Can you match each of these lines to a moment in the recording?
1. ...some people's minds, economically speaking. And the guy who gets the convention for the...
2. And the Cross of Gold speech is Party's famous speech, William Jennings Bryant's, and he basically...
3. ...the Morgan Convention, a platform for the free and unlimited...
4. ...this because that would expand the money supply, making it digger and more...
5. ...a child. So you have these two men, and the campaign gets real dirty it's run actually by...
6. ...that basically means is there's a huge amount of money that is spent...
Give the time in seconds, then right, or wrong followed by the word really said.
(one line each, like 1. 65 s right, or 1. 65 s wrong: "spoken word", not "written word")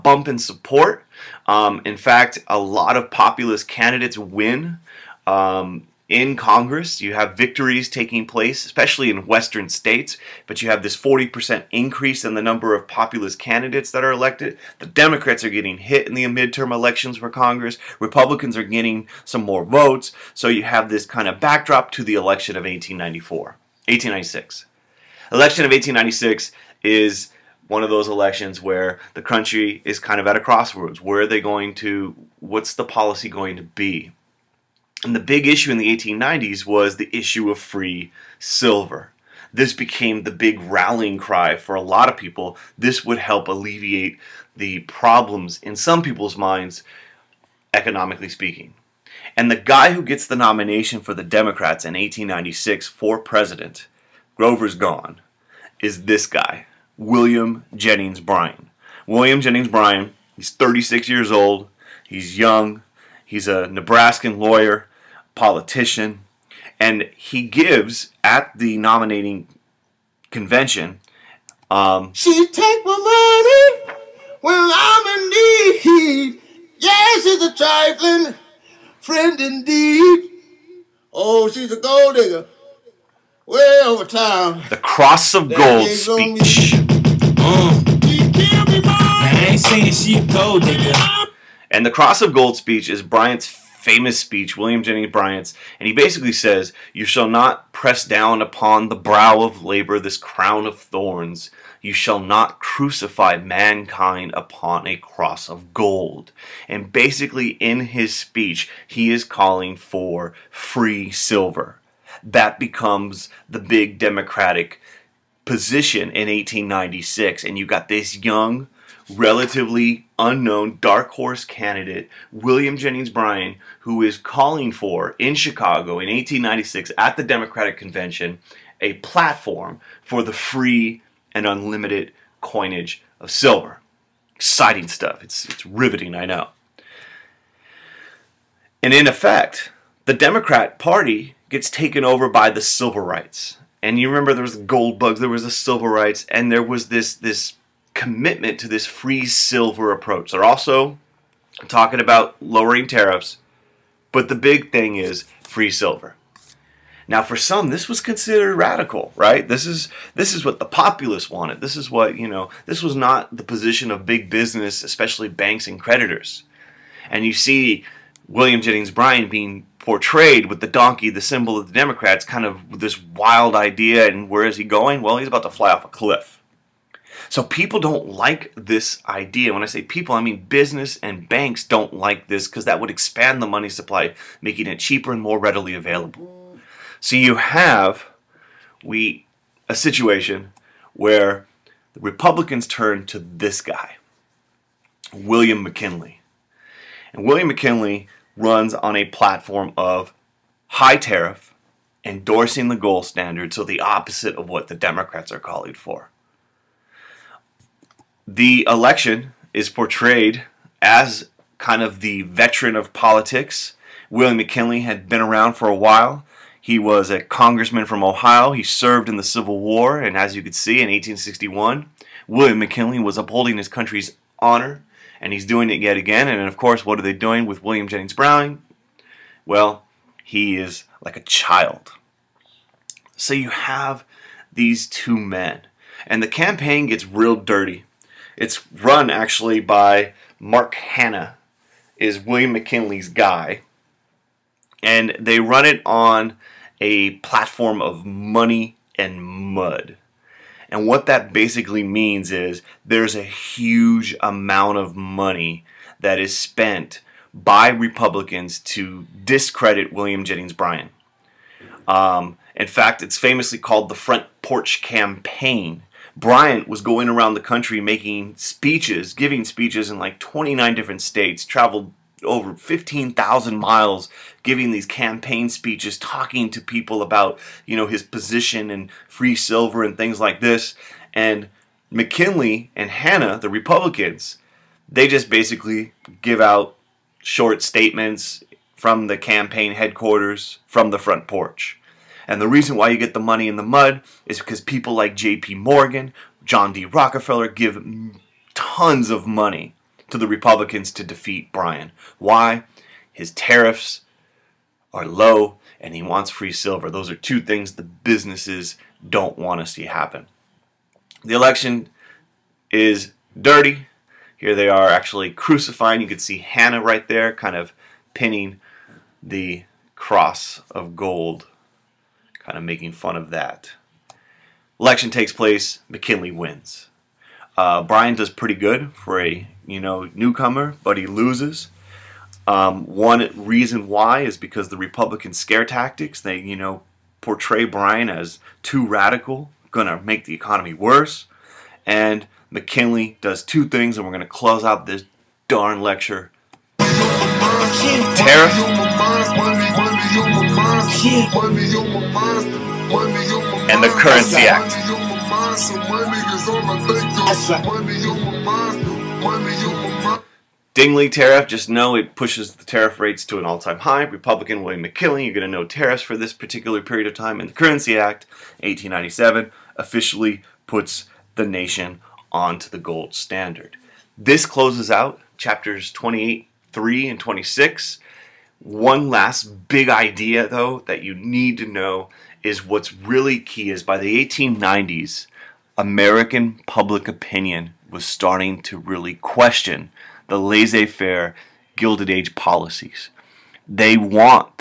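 1. 45 s wrong: "nomination", not "convention"
2. 91 s wrong: "Bryant", not "Party"
3. 127 s wrong: "Democratic", not "Morgan"
4. 182 s wrong: "cheaper", not "digger"
5. 231 s right
6. 251 s right.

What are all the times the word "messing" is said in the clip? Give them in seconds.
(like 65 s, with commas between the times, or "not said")
not said.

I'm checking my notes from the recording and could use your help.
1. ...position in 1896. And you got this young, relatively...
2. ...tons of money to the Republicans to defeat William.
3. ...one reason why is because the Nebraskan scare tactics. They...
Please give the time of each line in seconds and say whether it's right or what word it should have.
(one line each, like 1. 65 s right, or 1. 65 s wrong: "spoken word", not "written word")
1. 115 s right
2. 298 s wrong: "Bryan", not "William"
3. 332 s wrong: "Republican", not "Nebraskan".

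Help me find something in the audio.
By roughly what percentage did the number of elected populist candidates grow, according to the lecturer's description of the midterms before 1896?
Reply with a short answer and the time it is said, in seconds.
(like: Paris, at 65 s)
40%, at 10 s.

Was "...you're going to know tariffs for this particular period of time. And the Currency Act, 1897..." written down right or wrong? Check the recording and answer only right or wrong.
right.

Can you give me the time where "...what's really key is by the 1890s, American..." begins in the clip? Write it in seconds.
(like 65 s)
382 s.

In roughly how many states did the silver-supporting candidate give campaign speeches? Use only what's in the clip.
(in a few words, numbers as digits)
29.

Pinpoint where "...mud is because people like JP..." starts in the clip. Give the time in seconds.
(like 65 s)
293 s.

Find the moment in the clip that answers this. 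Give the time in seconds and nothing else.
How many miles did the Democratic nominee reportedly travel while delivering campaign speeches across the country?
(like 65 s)
272 s.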